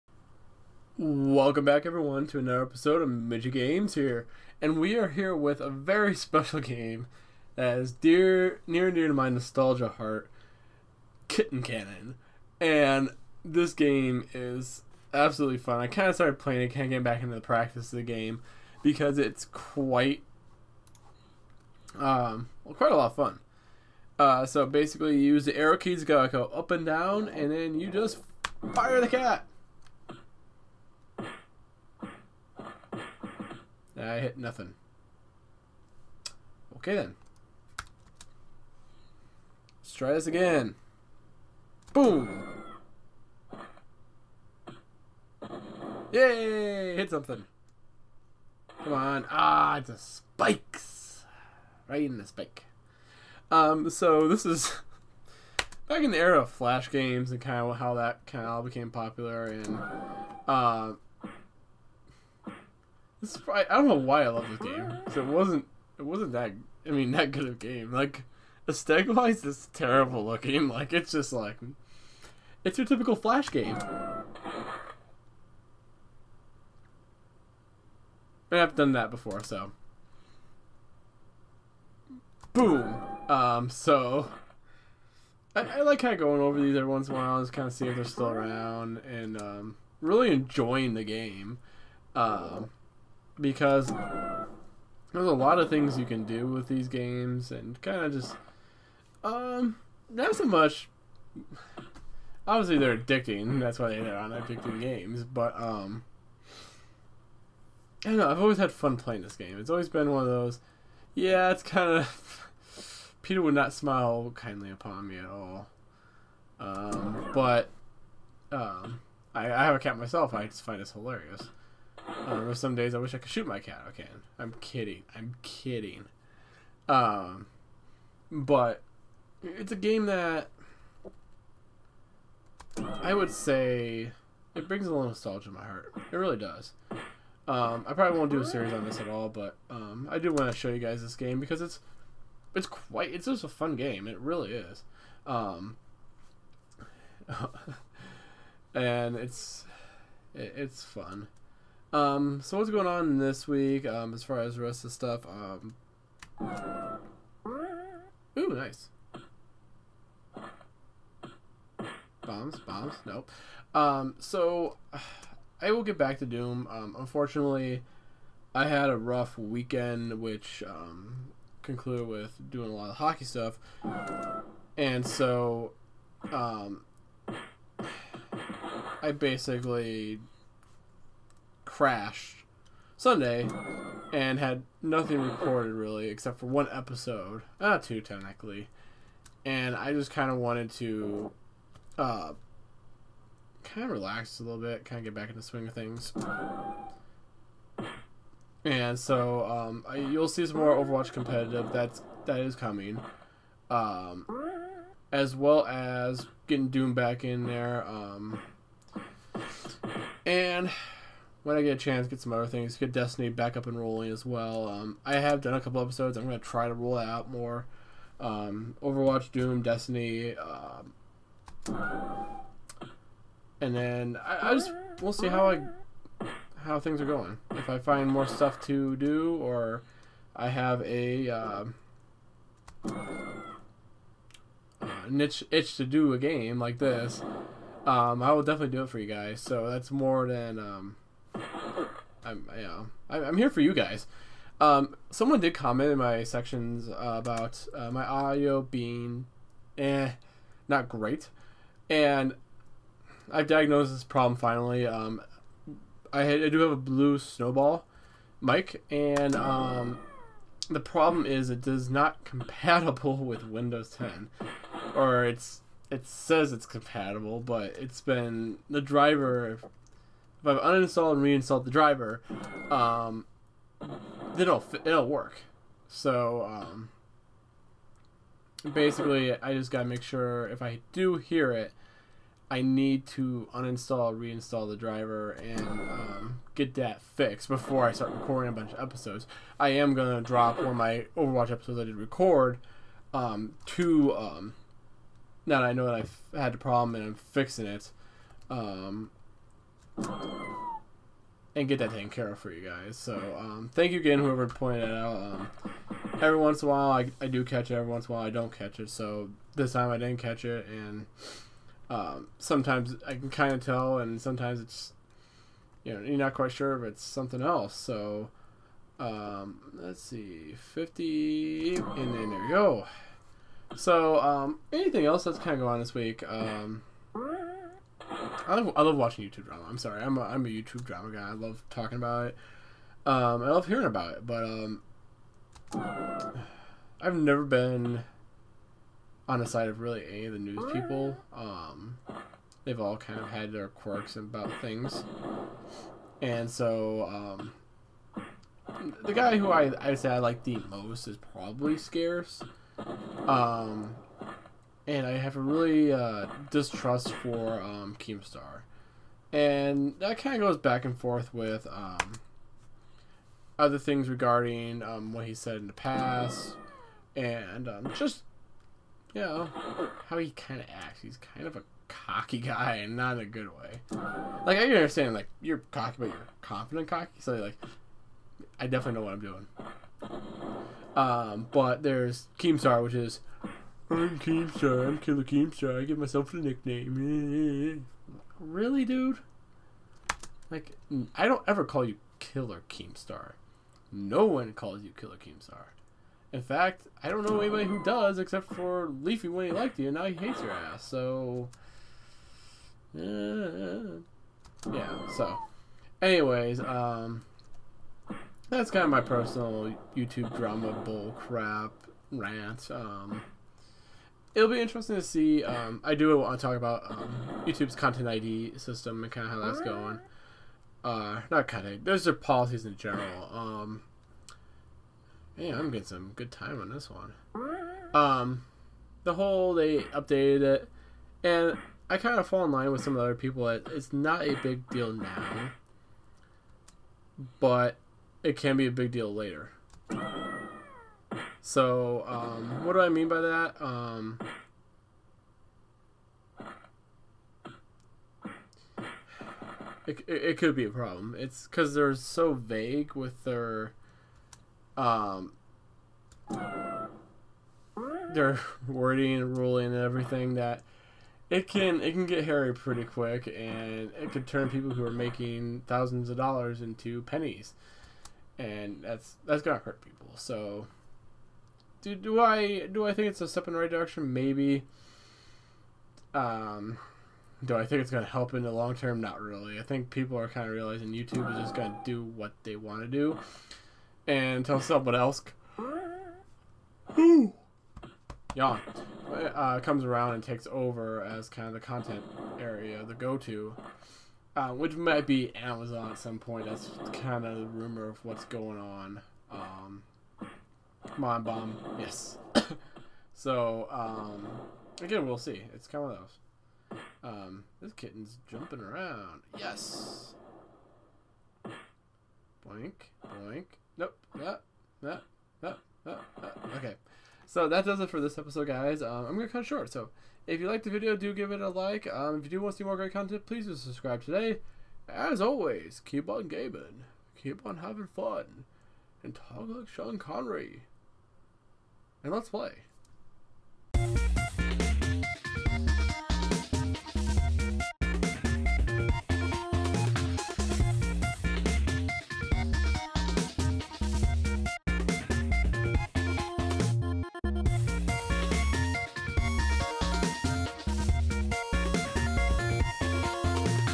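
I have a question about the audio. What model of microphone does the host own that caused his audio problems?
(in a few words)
Blue Snowball.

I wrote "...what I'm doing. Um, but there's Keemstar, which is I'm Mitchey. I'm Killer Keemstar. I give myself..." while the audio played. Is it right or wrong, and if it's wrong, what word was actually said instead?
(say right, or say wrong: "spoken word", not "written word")
wrong: "Keemstar", not "Mitchey".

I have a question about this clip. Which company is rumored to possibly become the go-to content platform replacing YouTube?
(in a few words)
Amazon.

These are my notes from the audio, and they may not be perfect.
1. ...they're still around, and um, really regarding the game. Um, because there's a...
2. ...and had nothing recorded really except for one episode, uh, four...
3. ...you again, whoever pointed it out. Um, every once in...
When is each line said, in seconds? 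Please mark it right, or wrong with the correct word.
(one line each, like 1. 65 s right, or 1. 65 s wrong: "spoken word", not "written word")
1. 87 s wrong: "enjoying", not "regarding"
2. 184 s wrong: "two", not "four"
3. 303 s right.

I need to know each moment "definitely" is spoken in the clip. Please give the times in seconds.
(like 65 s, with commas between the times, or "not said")
238 s, 378 s.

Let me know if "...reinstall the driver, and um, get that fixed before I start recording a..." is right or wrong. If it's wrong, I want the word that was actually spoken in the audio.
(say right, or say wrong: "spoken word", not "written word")
right.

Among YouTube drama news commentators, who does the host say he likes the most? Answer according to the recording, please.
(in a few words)
Scarce.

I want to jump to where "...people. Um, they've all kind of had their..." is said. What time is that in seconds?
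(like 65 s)
340 s.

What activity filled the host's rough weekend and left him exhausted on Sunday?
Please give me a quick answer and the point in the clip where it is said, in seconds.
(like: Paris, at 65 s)
hockey, at 172 s.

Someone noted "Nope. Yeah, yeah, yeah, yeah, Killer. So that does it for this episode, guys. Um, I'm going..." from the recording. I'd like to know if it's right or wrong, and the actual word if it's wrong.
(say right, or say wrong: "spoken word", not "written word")
wrong: "Okay", not "Killer".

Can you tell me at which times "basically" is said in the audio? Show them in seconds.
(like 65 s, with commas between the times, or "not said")
24 s, 179 s, 278 s.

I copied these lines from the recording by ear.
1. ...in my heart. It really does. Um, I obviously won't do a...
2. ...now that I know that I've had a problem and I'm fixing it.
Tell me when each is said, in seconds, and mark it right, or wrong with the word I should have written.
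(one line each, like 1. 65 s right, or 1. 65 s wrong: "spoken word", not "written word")
1. 135 s wrong: "probably", not "obviously"
2. 295 s right.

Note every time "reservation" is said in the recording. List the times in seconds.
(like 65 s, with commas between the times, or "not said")
not said.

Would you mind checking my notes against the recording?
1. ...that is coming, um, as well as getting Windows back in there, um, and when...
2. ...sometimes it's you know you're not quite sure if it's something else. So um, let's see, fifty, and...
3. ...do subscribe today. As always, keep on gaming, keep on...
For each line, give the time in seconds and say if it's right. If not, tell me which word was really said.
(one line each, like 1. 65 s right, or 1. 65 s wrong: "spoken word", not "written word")
1. 202 s wrong: "Doom", not "Windows"
2. 314 s right
3. 523 s right.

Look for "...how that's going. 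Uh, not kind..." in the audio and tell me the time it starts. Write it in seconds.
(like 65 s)
419 s.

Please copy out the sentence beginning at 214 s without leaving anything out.
Um, I have done a couple episodes.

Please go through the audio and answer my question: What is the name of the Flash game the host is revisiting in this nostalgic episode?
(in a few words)
Kitten Cannon.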